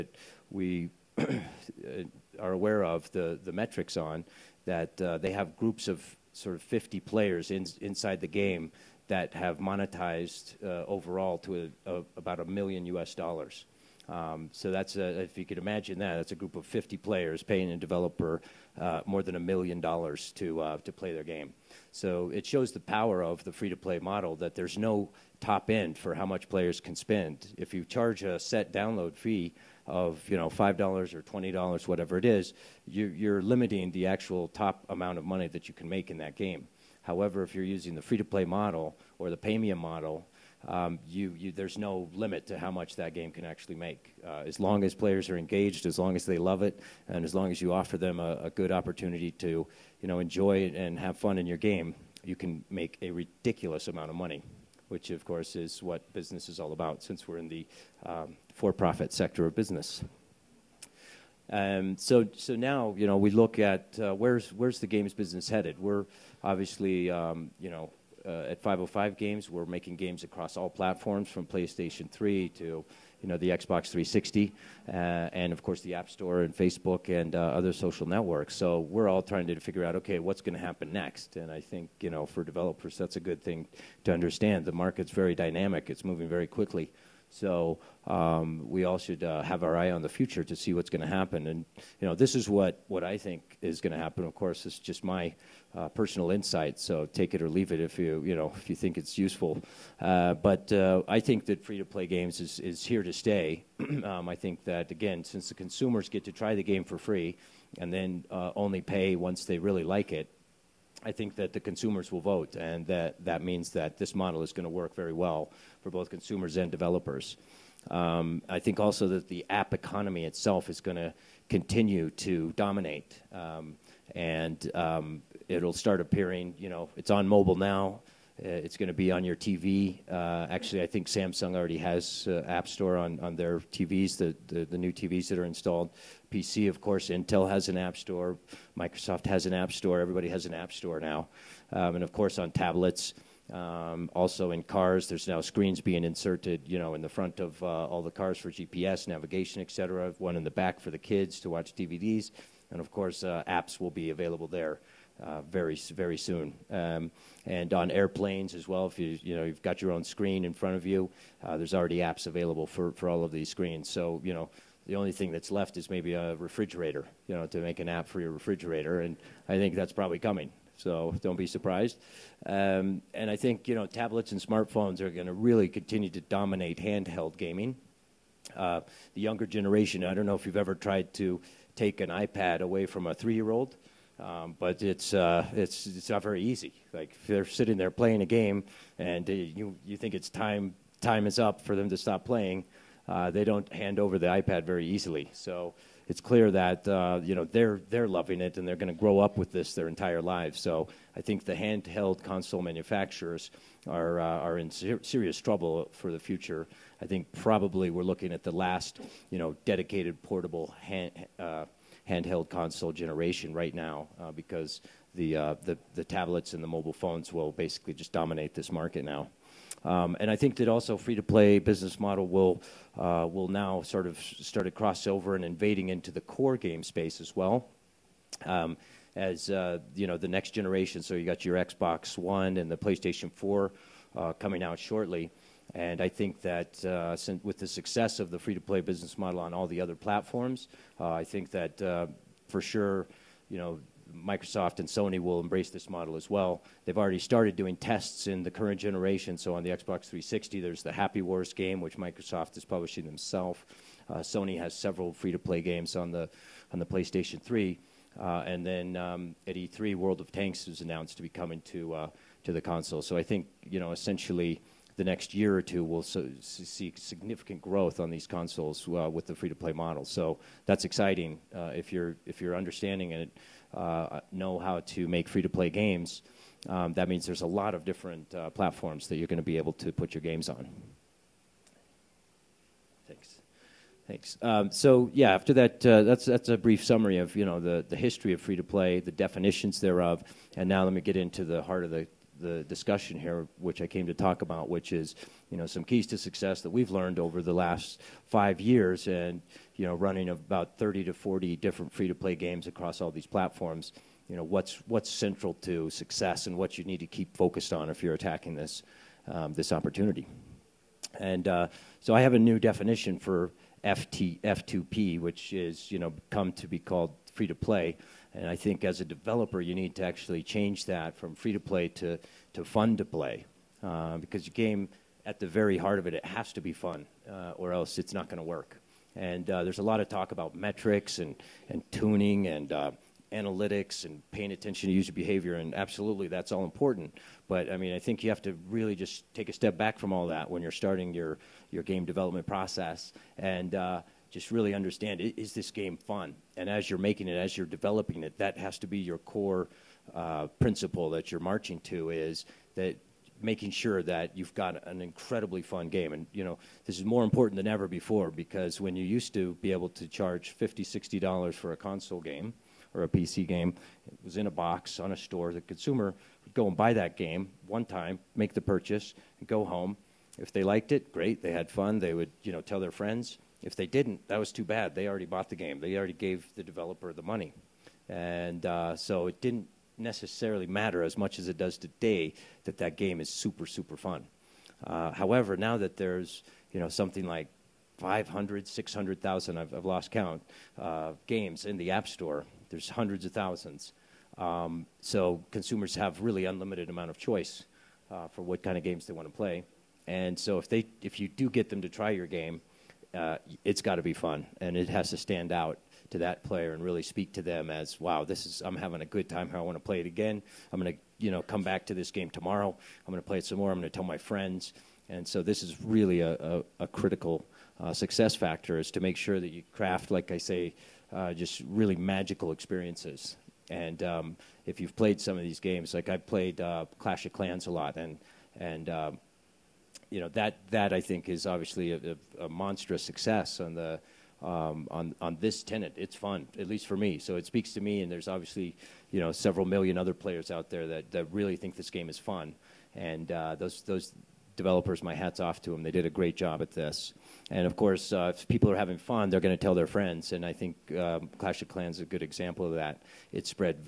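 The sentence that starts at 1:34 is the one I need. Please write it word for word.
Of course, it's just my uh, personal insight.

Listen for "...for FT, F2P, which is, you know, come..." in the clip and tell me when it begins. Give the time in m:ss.
5:13.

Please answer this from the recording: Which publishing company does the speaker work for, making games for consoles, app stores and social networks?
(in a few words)
505 Games.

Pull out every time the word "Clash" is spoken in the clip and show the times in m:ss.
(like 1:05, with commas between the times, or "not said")
7:06, 7:31.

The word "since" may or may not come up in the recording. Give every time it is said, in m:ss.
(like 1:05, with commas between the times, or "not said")
0:57, 1:45, 3:57.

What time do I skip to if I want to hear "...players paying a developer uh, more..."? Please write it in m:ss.
0:16.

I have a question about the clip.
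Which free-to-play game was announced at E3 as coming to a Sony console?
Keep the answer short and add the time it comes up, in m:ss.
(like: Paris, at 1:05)
World of Tanks, at 4:19.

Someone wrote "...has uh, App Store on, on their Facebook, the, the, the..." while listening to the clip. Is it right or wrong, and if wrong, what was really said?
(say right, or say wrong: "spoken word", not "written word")
wrong: "TVs", not "Facebook".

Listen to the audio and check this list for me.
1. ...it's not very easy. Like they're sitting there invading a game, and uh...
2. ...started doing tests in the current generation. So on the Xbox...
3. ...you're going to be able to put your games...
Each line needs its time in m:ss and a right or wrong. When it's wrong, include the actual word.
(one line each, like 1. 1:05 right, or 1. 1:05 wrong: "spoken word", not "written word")
1. 3:05 wrong: "playing", not "invading"
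2. 4:07 right
3. 4:39 right.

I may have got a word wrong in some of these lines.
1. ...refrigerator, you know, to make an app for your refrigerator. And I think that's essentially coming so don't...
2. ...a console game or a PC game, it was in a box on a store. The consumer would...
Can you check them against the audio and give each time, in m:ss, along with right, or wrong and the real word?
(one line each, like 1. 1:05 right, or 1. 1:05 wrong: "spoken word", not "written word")
1. 2:46 wrong: "probably", not "essentially"
2. 6:01 right.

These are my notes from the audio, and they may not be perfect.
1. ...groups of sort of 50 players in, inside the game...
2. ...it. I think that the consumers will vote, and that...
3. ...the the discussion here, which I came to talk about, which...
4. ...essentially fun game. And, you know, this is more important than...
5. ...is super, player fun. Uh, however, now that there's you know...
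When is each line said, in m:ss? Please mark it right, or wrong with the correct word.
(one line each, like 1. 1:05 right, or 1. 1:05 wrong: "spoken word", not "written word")
1. 0:05 right
2. 1:50 right
3. 4:51 right
4. 5:55 wrong: "incredibly", not "essentially"
5. 6:23 wrong: "super", not "player".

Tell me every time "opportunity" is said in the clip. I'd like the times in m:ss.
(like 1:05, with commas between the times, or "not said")
0:48, 5:09.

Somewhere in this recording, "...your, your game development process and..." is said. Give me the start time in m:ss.
5:41.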